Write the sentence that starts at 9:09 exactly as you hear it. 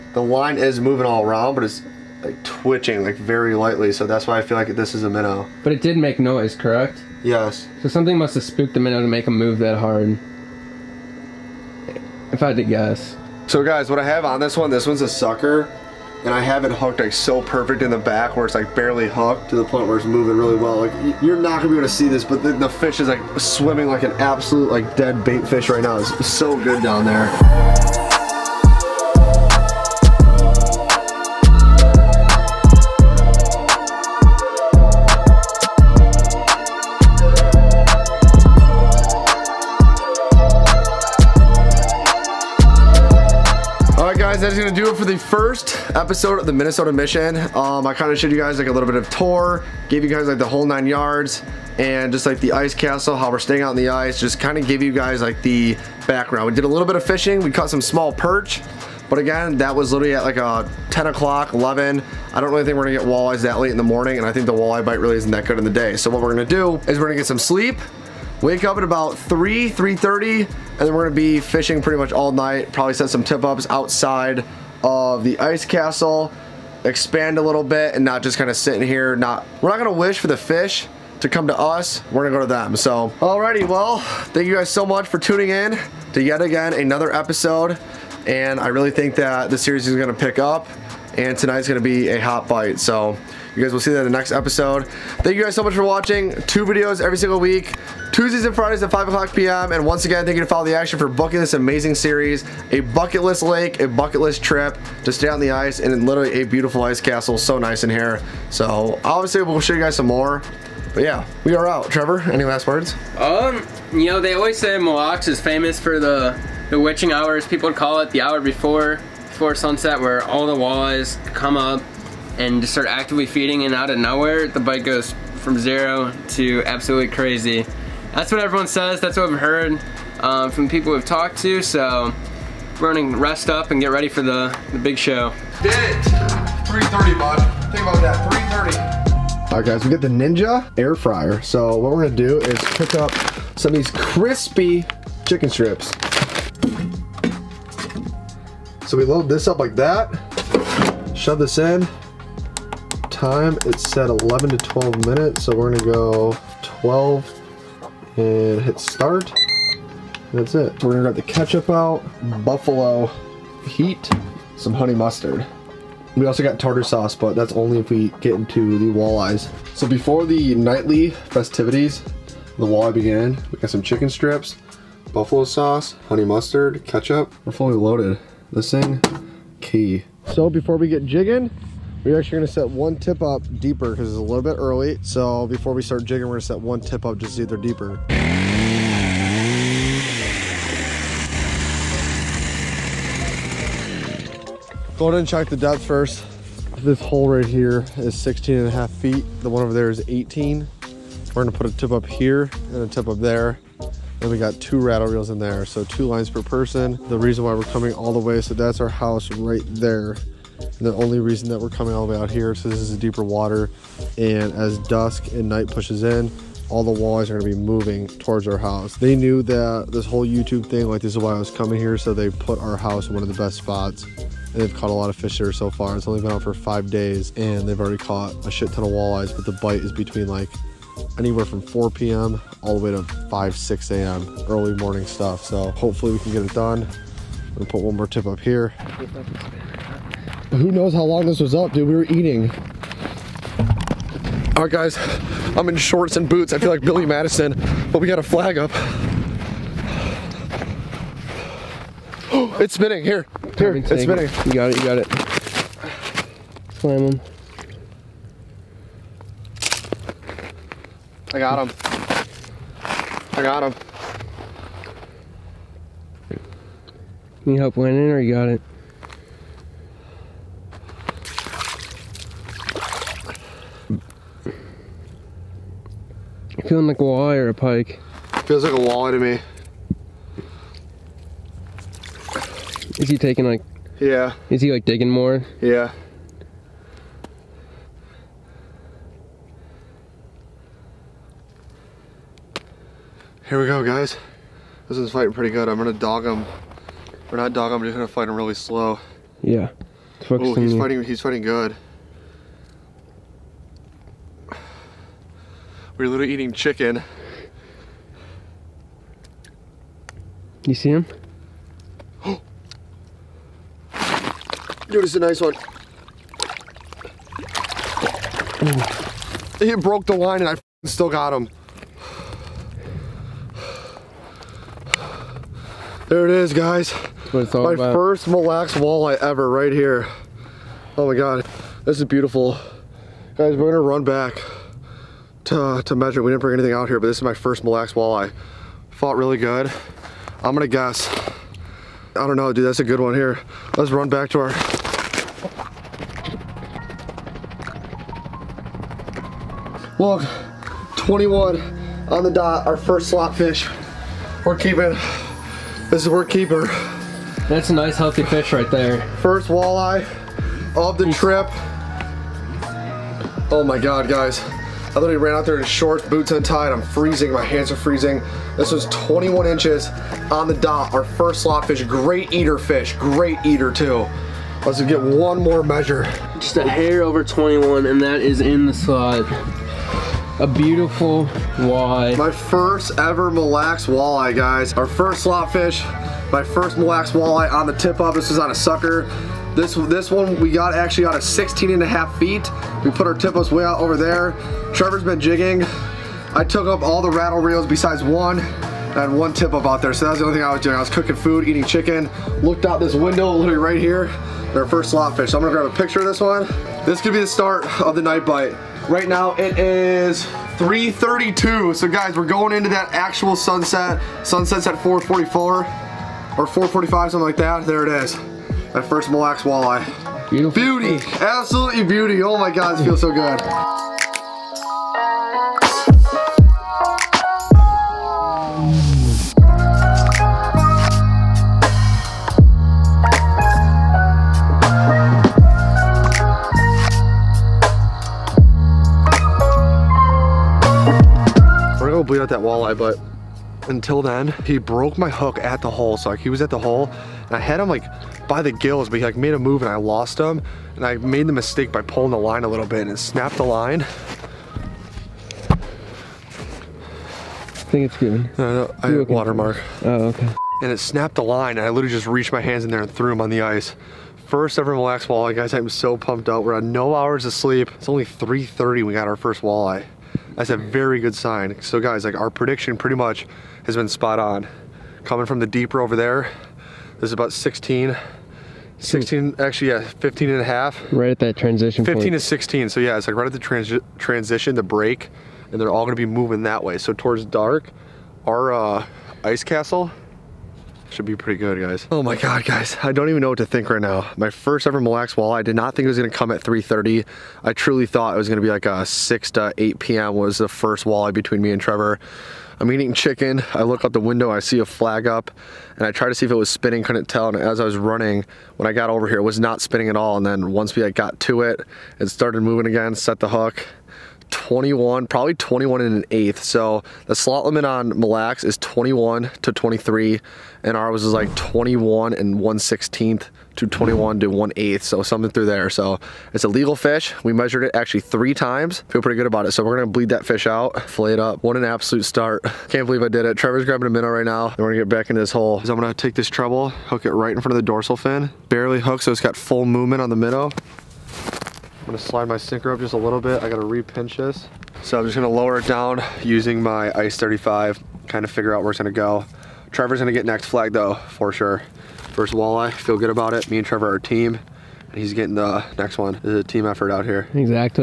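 Trevor's gonna get next flag though, for sure.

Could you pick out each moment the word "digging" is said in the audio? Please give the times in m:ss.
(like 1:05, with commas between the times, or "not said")
4:44.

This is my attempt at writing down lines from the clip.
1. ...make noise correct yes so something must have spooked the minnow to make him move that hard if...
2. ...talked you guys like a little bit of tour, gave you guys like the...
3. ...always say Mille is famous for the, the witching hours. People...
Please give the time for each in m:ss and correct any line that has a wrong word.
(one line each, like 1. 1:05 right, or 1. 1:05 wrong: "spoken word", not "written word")
1. 0:05 right
2. 0:48 wrong: "showed", not "talked"
3. 1:54 right.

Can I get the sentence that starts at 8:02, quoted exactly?
to 16, so yeah, it's like right at the transi transition, the break, and they're all gonna be moving that way.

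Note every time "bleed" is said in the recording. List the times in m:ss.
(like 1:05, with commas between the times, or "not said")
7:22, 8:49.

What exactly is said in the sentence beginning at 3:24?
And we got two rattle reels in there.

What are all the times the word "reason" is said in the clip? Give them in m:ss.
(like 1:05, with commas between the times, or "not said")
3:27, 3:31.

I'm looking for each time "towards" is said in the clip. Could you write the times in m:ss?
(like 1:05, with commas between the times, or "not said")
3:38, 8:06.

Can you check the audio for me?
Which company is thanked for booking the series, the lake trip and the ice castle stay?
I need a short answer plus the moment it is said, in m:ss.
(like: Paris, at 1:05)
Follow the Action, at 1:40.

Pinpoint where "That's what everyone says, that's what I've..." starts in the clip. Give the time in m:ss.
2:08.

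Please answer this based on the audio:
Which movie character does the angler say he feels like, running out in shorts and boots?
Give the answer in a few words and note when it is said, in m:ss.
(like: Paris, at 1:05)
Billy Madison, at 4:06.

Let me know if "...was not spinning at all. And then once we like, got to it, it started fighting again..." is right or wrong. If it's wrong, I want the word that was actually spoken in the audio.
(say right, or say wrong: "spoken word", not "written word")
wrong: "moving", not "fighting".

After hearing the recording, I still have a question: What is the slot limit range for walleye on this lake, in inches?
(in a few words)
21 to 23.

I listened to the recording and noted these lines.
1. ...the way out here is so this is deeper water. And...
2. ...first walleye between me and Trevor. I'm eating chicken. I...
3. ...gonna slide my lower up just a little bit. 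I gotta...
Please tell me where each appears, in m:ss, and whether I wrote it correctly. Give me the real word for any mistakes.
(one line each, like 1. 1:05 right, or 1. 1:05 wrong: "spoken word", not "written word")
1. 3:32 right
2. 8:20 right
3. 9:01 wrong: "sinker", not "lower".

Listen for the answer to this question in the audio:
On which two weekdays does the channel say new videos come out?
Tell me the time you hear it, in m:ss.
1:38.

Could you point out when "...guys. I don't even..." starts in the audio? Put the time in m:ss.
8:12.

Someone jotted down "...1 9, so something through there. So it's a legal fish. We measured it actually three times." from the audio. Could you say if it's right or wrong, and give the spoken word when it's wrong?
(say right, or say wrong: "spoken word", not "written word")
wrong: "8", not "9".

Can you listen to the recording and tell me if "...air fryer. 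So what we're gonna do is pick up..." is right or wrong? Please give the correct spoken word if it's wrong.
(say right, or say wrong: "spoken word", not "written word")
right.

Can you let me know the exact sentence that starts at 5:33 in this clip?
Guys, we're gonna run back to, to measure.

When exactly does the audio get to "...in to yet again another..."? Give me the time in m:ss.
1:25.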